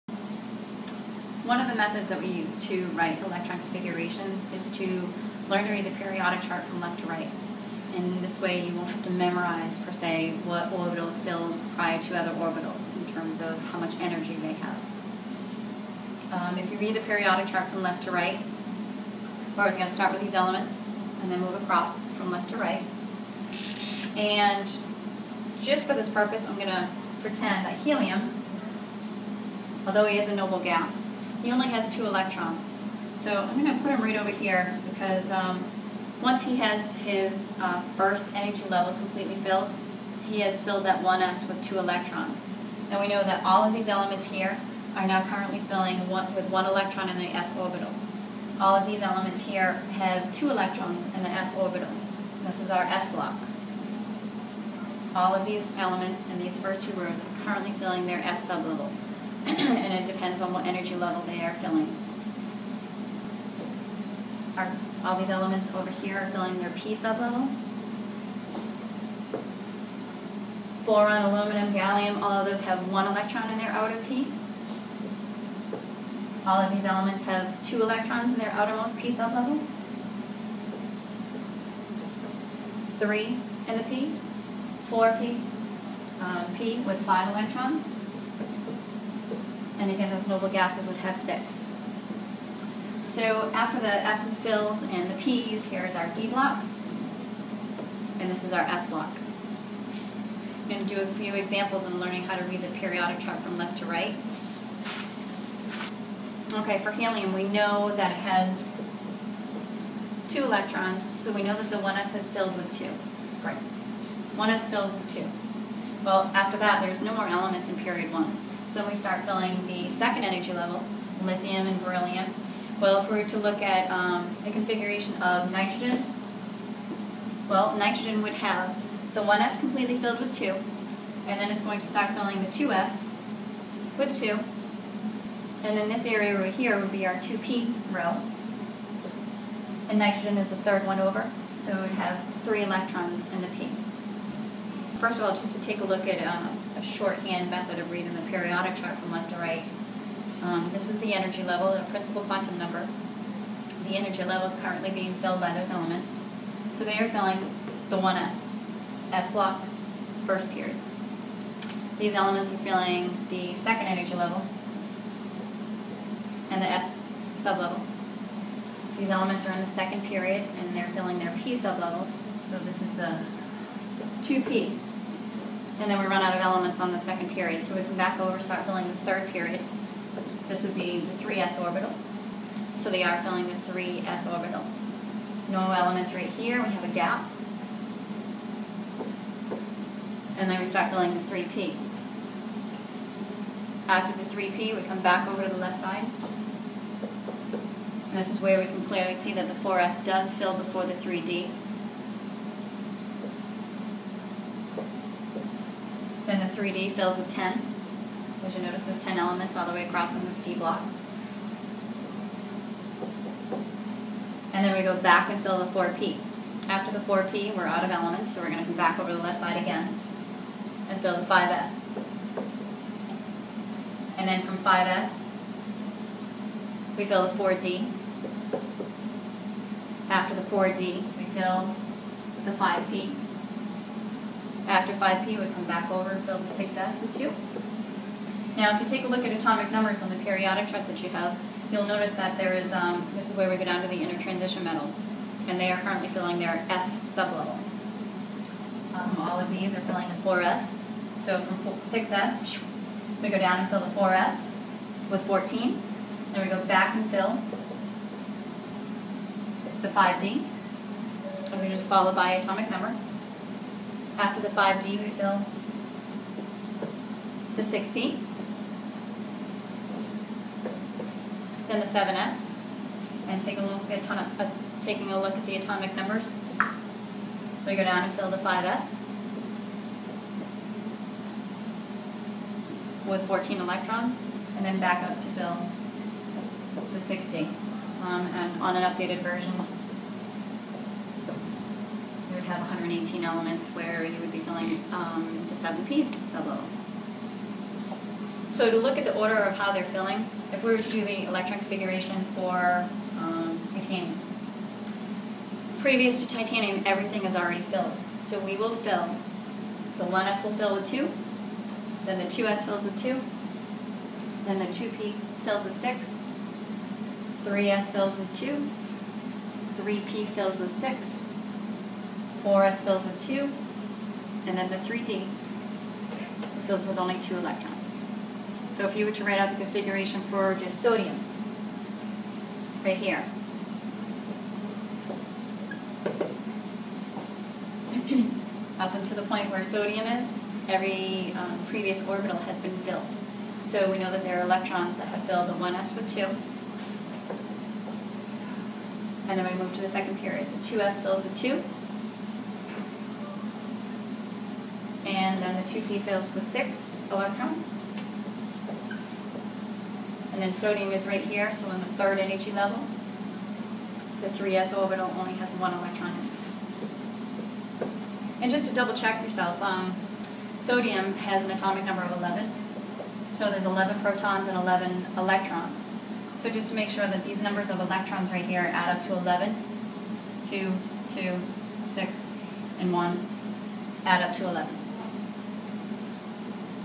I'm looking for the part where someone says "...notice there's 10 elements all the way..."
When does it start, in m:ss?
3:28.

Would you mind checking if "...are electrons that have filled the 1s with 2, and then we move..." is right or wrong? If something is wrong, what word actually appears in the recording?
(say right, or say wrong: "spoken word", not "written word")
right.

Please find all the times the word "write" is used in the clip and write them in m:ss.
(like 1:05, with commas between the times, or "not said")
0:02, 5:29.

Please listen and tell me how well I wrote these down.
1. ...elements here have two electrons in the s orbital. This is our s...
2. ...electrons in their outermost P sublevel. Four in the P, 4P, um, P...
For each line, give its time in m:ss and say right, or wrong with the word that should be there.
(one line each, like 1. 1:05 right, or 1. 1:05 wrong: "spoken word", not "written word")
1. 0:49 right
2. 1:17 wrong: "Three", not "Four".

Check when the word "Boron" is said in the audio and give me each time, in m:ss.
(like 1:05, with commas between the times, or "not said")
1:10.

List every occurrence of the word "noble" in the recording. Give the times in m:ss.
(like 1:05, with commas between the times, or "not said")
0:30, 1:30.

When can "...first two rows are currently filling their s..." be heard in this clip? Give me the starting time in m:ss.
0:56.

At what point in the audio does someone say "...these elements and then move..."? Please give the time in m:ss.
0:20.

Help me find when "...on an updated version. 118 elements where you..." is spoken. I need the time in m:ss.
4:48.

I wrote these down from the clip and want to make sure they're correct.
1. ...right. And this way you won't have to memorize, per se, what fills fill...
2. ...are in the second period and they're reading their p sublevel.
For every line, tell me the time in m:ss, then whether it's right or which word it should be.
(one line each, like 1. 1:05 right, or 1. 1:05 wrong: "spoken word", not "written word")
1. 0:07 wrong: "orbitals", not "fills"
2. 2:49 wrong: "filling", not "reading".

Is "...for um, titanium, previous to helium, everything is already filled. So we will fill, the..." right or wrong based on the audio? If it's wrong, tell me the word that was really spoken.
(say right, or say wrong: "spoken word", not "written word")
wrong: "titanium", not "helium".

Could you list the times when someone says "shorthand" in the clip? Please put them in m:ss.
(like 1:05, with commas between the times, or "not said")
2:26.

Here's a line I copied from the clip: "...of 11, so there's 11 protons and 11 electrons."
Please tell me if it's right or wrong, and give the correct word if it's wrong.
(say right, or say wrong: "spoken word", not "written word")
right.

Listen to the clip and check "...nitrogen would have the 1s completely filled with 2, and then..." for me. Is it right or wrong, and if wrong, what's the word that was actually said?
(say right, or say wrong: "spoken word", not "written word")
right.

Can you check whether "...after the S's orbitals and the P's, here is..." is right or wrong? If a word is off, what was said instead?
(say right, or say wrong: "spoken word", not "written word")
wrong: "fills", not "orbitals".